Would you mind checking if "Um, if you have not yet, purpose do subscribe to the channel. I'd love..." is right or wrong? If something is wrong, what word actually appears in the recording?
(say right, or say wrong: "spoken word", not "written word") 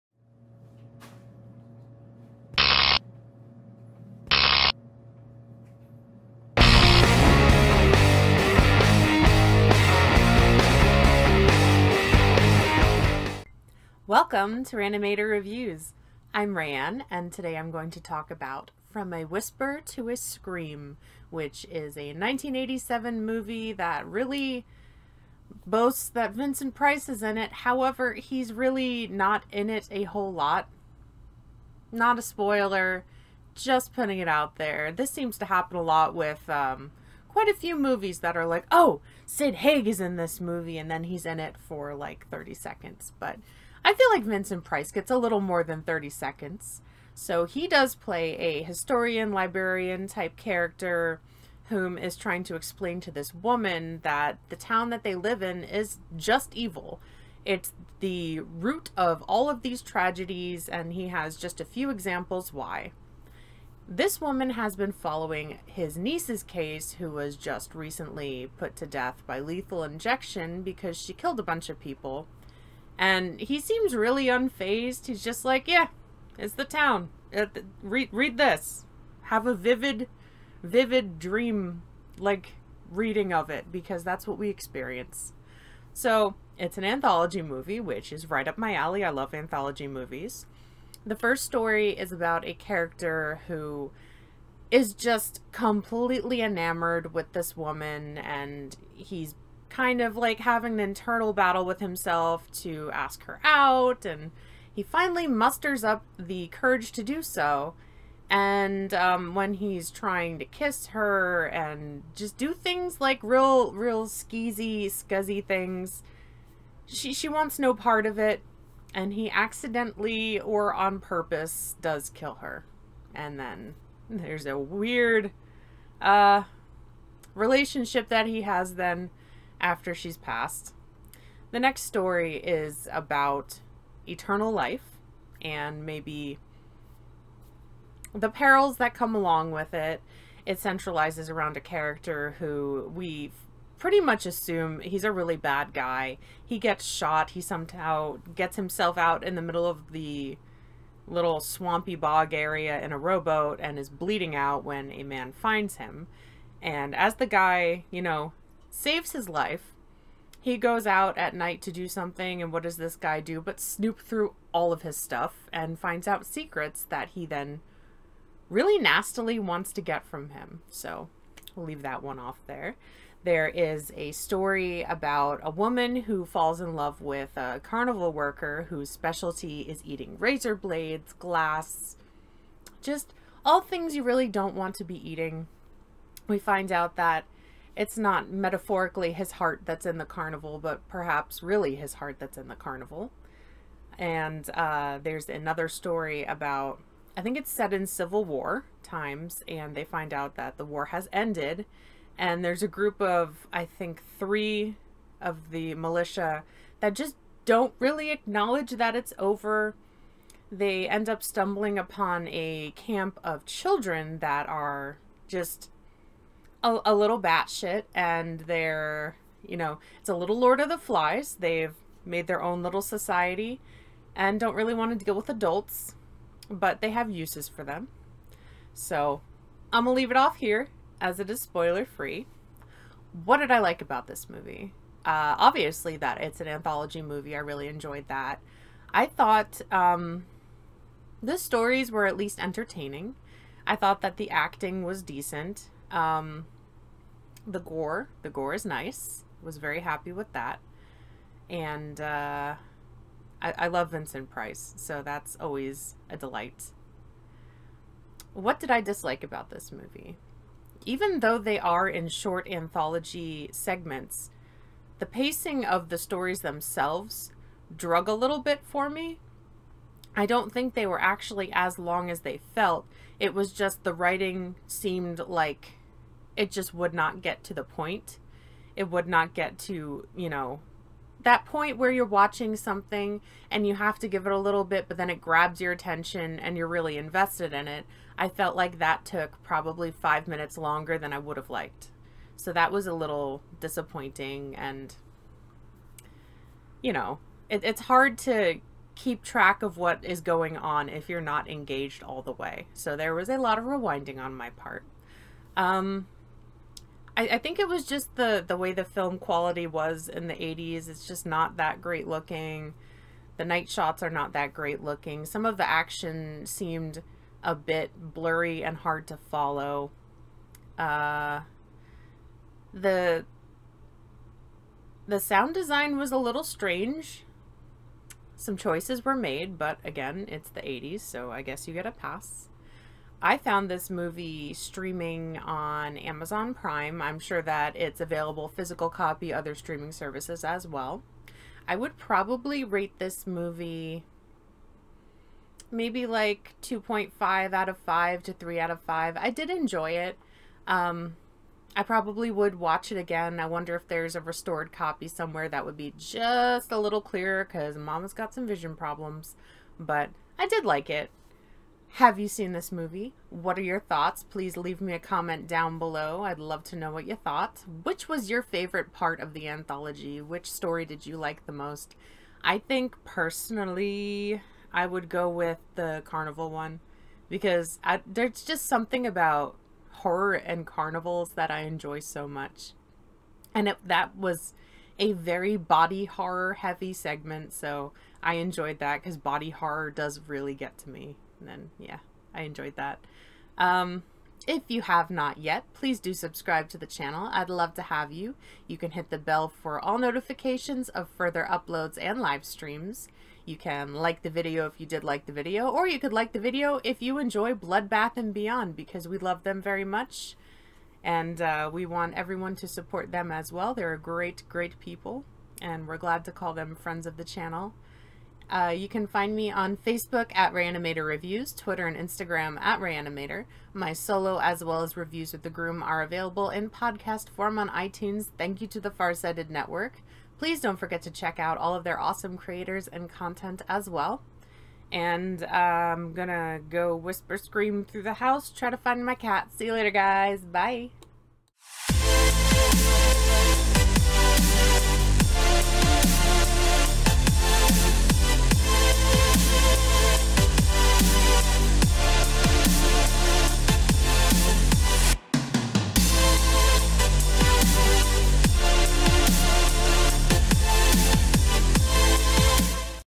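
wrong: "please", not "purpose".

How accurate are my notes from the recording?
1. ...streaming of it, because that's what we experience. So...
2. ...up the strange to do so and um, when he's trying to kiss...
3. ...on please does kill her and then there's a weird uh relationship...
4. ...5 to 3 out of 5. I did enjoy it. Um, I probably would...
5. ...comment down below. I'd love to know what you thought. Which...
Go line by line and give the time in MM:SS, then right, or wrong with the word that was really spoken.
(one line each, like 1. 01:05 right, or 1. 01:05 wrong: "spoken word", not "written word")
1. 01:22 wrong: "reading", not "streaming"
2. 01:45 wrong: "courage", not "strange"
3. 02:00 wrong: "purpose", not "please"
4. 05:47 right
5. 06:04 right.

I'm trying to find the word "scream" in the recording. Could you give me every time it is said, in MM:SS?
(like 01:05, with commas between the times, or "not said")
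00:20, 07:17.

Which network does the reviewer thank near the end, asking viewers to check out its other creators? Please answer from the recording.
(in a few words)
Farsighted Network.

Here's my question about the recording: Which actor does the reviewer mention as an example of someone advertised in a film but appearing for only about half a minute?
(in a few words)
Sid Haig.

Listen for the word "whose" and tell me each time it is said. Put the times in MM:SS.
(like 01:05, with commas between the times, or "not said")
02:58.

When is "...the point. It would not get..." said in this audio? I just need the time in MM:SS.
04:37.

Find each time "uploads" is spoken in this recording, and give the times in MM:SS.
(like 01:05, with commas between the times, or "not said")
06:41.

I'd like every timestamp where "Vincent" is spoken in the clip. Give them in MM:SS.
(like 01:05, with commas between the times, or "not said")
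00:26, 00:44, 04:13.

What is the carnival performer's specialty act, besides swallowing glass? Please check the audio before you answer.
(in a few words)
Eating razor blades.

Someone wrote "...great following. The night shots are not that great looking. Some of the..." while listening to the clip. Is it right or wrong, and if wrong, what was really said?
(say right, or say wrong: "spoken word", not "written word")
wrong: "looking", not "following".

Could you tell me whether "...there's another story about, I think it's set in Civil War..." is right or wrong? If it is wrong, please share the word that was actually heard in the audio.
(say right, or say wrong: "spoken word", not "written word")
right.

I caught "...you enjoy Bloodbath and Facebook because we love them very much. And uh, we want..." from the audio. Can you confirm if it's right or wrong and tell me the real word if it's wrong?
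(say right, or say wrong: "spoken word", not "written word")
wrong: "Beyond", not "Facebook".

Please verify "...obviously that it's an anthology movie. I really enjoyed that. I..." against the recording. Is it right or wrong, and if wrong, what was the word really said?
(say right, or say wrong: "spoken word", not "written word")
right.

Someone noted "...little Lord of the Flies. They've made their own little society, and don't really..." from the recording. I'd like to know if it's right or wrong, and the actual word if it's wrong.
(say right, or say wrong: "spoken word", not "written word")
right.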